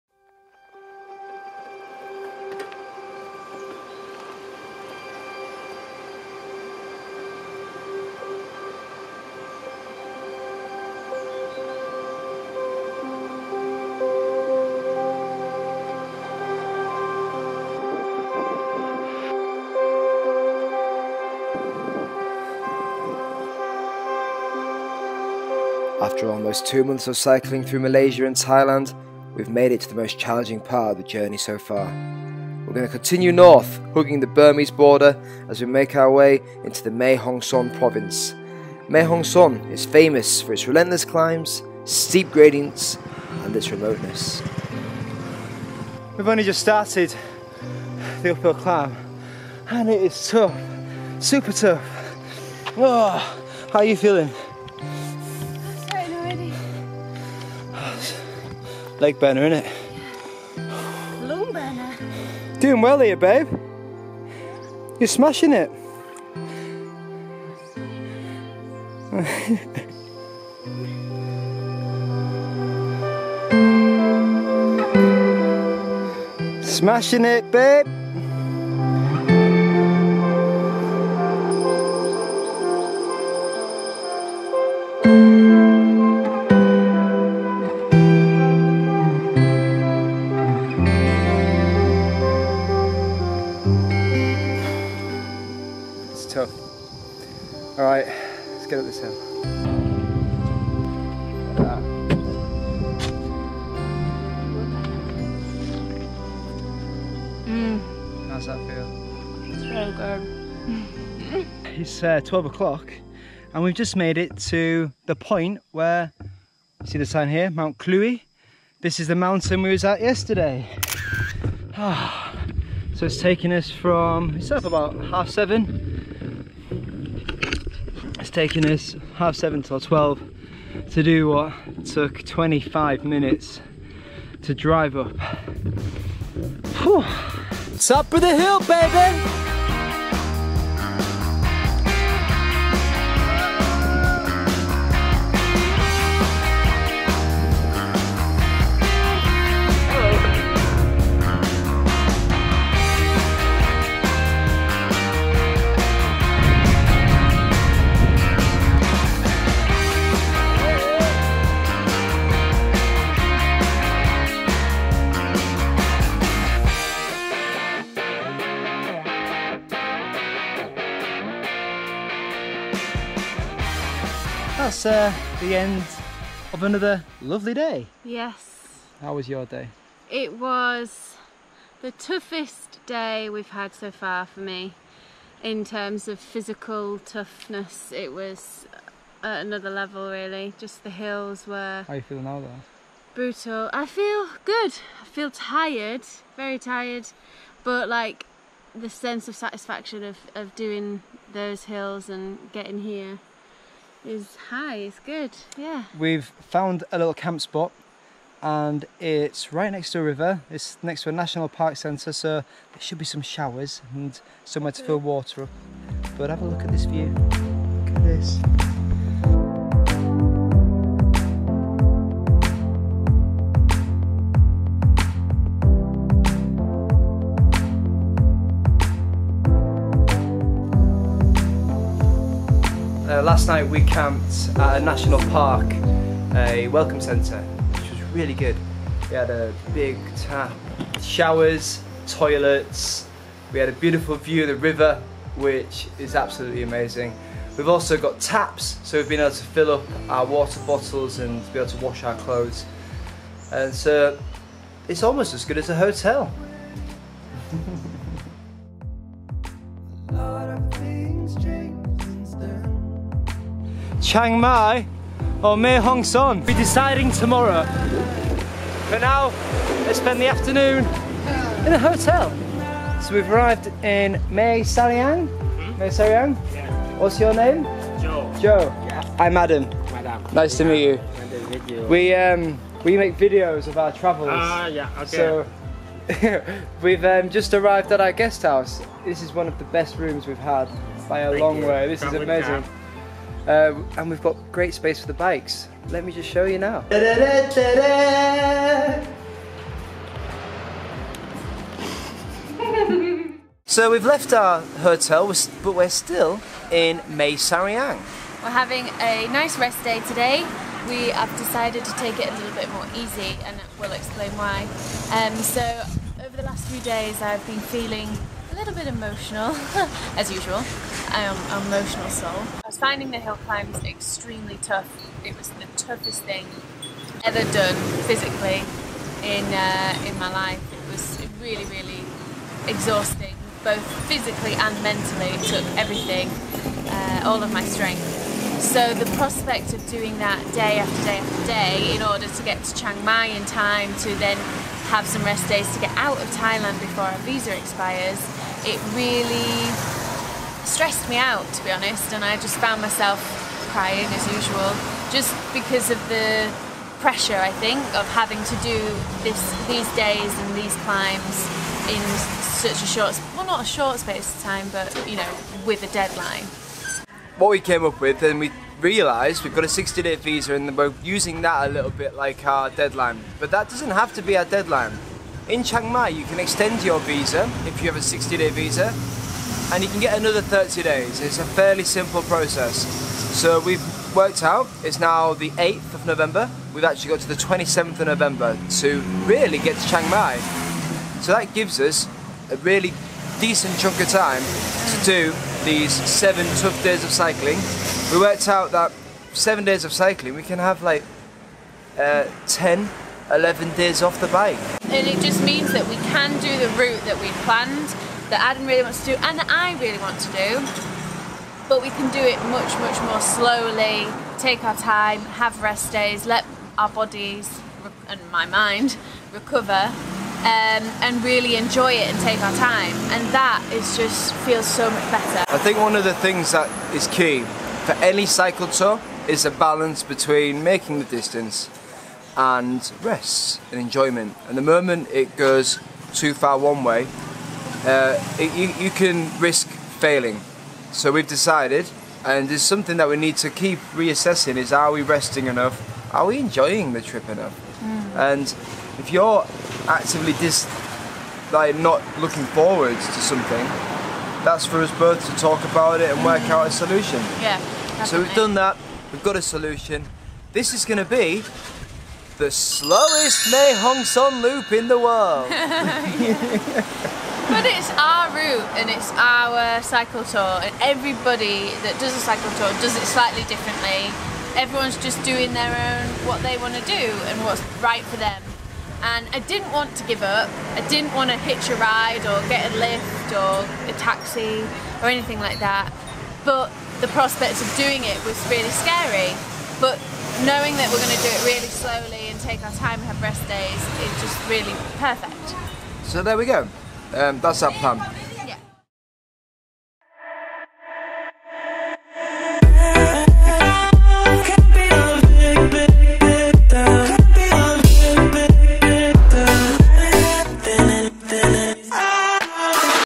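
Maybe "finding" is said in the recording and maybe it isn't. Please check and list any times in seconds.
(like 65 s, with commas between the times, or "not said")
322 s.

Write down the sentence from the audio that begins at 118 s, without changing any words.
This is the mountain we was at yesterday.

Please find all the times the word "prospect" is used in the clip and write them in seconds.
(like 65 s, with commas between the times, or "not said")
339 s, 487 s.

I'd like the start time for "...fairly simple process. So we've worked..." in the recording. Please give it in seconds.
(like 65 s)
381 s.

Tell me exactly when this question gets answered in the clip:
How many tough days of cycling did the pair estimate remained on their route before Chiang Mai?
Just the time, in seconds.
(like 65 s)
395 s.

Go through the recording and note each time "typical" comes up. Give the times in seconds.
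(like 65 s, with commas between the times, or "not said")
not said.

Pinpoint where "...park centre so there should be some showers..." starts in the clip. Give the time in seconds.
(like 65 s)
211 s.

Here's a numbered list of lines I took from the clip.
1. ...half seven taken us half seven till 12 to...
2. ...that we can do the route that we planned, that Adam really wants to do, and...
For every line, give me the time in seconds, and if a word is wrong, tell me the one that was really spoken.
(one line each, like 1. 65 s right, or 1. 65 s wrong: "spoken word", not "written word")
1. 125 s right
2. 405 s right.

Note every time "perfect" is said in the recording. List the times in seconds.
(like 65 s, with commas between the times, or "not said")
494 s.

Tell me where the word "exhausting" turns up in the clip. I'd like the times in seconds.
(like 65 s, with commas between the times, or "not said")
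332 s.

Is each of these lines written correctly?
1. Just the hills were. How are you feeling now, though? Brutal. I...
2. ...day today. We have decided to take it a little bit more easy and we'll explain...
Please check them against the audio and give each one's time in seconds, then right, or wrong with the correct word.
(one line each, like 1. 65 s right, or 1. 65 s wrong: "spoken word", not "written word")
1. 190 s right
2. 309 s right.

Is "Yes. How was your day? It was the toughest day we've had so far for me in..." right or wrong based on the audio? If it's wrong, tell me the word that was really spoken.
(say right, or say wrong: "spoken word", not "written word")
right.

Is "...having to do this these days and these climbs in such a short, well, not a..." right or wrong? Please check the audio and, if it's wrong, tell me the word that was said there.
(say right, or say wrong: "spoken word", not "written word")
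right.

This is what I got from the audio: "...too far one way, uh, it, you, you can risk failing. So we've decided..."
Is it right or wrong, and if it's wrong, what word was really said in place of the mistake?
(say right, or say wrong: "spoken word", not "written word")
right.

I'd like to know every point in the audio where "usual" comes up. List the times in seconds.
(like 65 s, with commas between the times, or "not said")
320 s, 354 s.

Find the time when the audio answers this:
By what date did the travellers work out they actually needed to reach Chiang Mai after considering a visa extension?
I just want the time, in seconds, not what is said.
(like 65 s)
387 s.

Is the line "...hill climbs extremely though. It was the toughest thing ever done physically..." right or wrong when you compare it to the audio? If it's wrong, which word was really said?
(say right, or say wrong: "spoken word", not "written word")
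wrong: "tough", not "though".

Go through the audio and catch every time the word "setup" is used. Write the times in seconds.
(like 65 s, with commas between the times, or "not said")
not said.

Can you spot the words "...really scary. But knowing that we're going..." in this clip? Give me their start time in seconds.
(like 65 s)
488 s.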